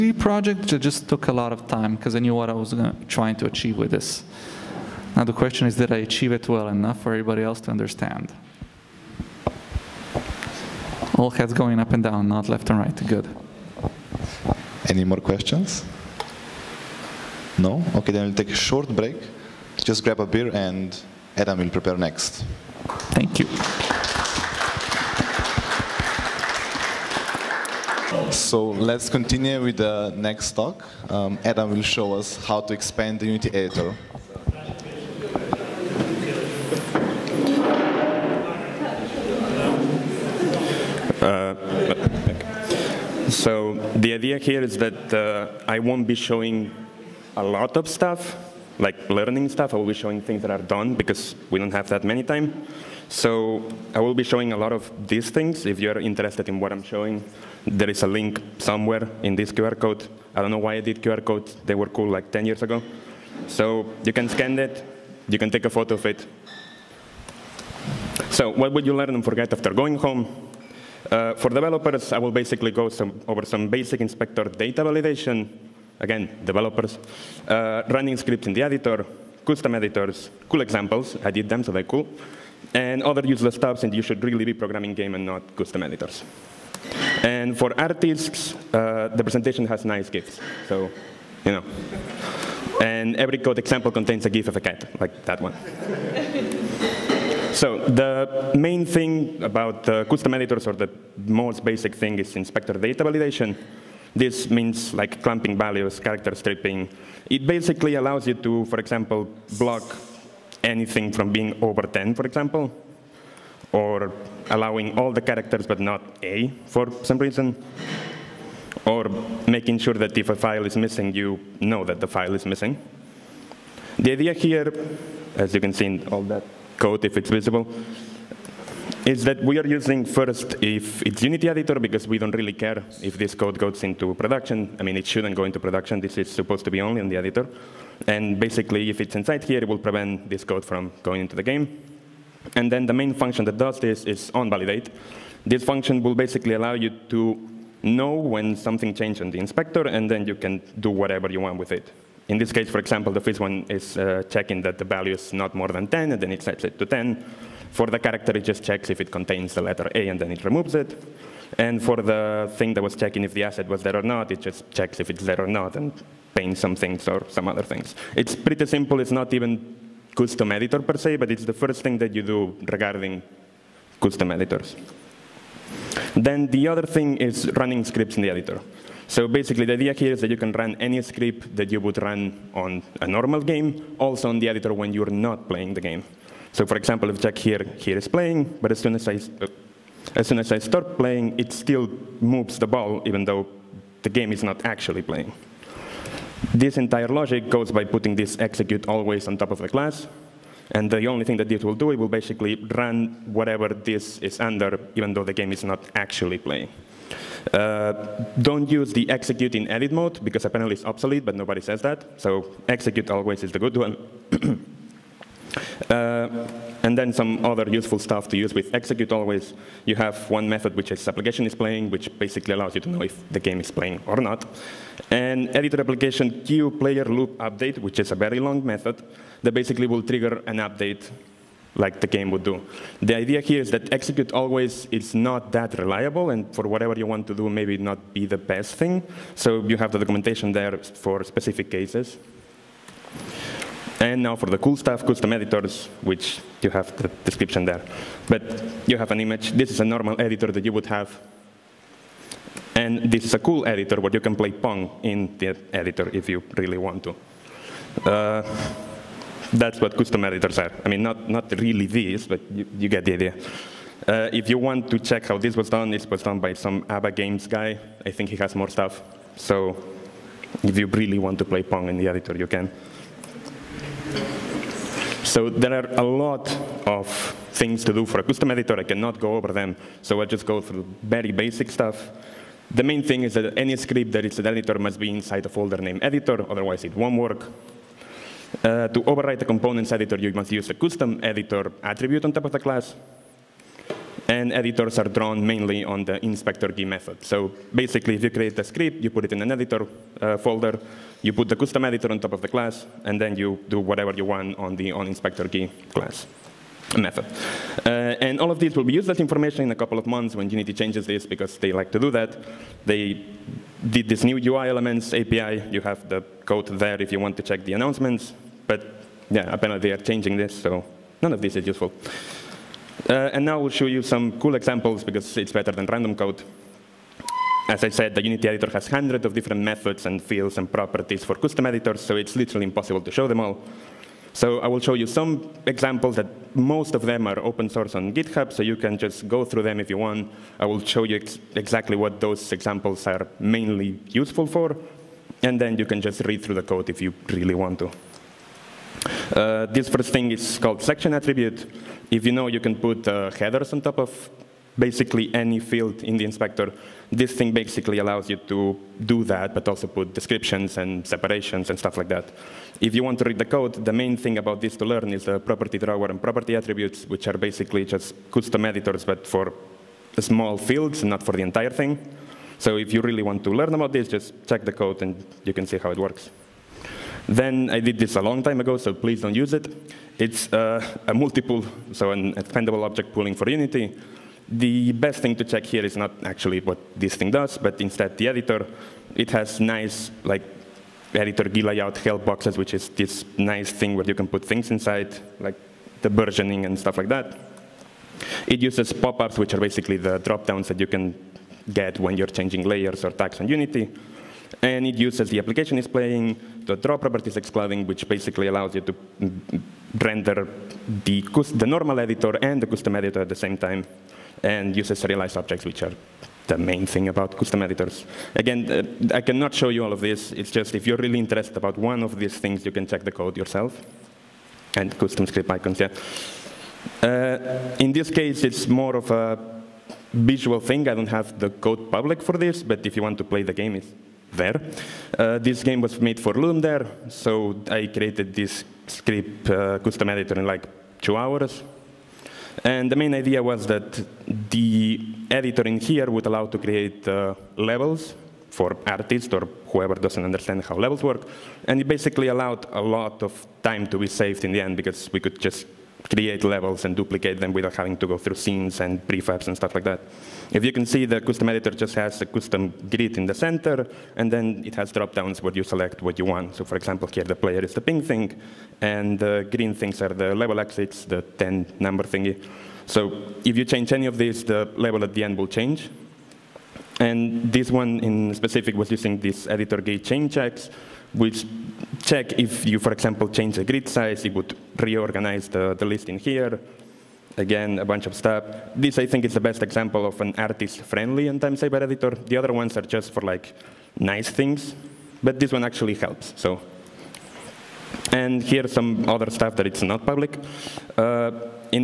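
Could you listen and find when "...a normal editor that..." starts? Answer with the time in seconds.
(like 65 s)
249 s.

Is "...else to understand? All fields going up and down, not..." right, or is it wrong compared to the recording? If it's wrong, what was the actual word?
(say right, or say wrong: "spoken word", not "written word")
wrong: "heads", not "fields".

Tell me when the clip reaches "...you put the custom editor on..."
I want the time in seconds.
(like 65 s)
301 s.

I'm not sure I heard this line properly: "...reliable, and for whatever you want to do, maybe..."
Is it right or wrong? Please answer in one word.
right.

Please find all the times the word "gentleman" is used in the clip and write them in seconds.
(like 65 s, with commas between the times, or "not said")
not said.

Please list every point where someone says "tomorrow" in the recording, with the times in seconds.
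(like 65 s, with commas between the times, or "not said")
not said.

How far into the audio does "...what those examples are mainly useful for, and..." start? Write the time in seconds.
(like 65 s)
341 s.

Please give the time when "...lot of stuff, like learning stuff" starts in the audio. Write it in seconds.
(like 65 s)
47 s.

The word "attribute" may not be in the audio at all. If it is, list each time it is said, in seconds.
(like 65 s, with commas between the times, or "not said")
291 s, 351 s, 366 s.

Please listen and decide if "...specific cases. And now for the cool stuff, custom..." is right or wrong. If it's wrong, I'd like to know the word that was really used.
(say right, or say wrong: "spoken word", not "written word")
right.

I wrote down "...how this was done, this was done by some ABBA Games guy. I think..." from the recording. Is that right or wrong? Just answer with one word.
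right.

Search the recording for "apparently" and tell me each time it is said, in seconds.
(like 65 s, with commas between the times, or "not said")
210 s, 319 s.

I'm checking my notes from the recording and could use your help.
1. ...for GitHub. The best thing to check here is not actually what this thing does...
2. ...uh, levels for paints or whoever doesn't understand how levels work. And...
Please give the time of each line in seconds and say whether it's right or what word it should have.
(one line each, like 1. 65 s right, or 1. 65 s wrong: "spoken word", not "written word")
1. 383 s wrong: "Unity", not "GitHub"
2. 447 s wrong: "artists", not "paints".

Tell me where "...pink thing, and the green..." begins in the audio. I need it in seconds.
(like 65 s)
467 s.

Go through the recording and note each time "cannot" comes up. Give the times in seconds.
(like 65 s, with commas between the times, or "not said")
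278 s, 419 s.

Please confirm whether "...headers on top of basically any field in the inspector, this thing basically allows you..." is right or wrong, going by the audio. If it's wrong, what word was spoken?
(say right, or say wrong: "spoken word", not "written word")
right.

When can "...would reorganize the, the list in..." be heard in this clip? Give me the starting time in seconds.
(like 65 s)
484 s.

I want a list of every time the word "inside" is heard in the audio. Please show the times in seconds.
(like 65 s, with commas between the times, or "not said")
139 s, 285 s, 394 s.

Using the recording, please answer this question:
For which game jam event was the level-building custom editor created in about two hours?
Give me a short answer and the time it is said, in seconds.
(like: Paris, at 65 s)
Ludum Dare, at 436 s.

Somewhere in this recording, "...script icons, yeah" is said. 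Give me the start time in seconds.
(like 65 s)
425 s.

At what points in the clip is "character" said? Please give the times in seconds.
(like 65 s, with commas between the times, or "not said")
106 s, 115 s, 157 s.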